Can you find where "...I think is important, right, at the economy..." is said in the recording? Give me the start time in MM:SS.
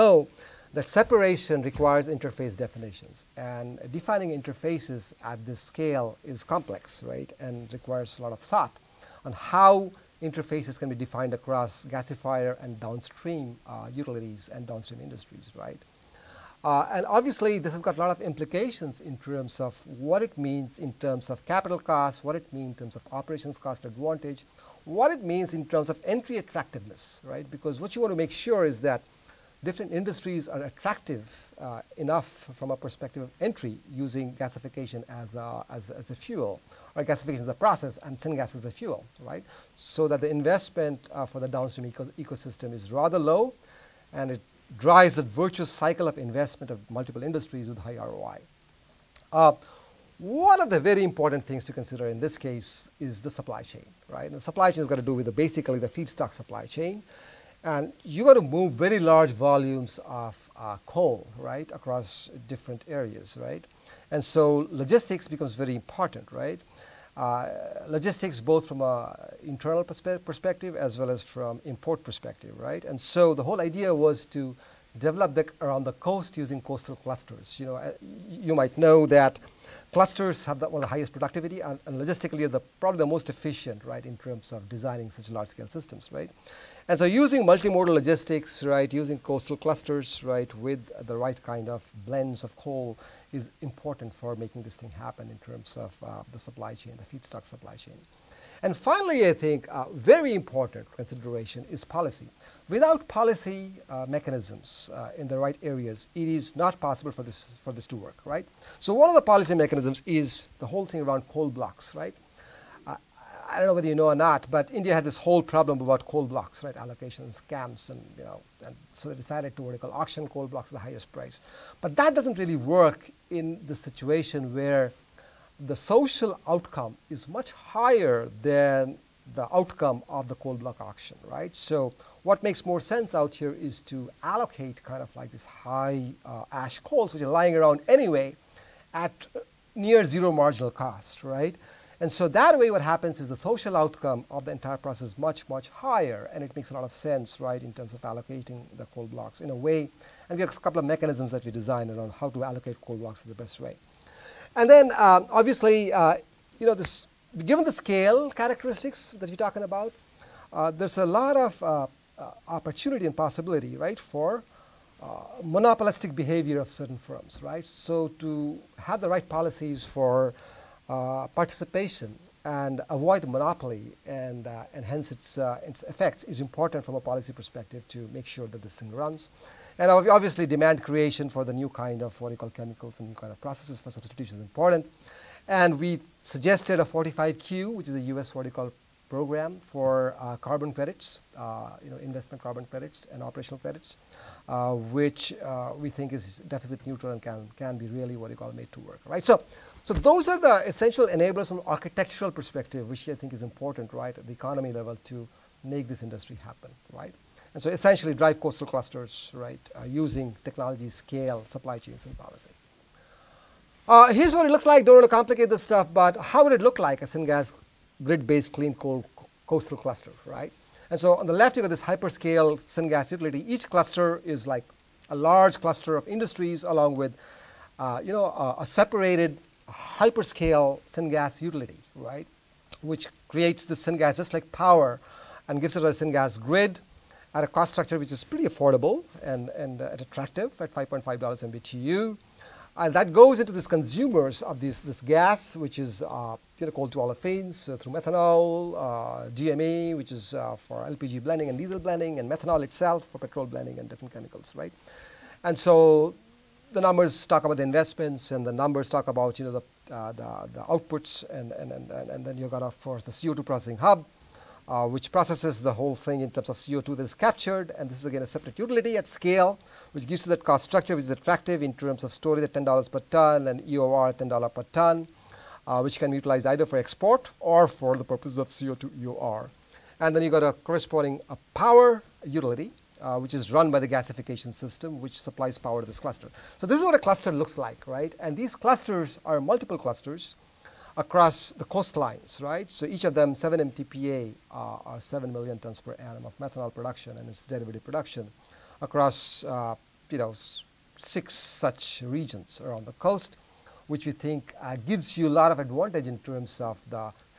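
03:23.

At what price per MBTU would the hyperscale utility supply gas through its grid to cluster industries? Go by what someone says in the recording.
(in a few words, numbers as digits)
$5.5.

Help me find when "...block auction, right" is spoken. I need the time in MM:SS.
02:10.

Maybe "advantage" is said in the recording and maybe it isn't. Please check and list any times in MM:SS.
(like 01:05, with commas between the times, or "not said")
00:23, 05:05.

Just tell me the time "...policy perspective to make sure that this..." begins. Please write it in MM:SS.
02:57.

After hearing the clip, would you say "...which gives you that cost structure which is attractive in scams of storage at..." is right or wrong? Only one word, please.
wrong.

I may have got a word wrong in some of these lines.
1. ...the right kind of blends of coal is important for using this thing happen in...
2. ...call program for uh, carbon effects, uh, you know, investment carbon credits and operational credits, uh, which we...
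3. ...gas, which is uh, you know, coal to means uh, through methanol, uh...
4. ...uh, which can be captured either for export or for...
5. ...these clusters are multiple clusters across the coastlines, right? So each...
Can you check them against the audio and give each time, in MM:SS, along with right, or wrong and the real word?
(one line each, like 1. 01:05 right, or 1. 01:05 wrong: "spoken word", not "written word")
1. 01:31 wrong: "making", not "using"
2. 03:08 wrong: "credits", not "effects"
3. 04:05 wrong: "olefins", not "means"
4. 04:35 wrong: "utilized", not "captured"
5. 04:48 right.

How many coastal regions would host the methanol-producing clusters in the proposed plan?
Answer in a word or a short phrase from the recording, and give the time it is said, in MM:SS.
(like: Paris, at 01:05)
6, at 05:00.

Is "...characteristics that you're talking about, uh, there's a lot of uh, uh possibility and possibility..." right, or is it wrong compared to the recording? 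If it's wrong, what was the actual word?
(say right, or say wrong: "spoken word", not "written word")
wrong: "opportunity", not "possibility".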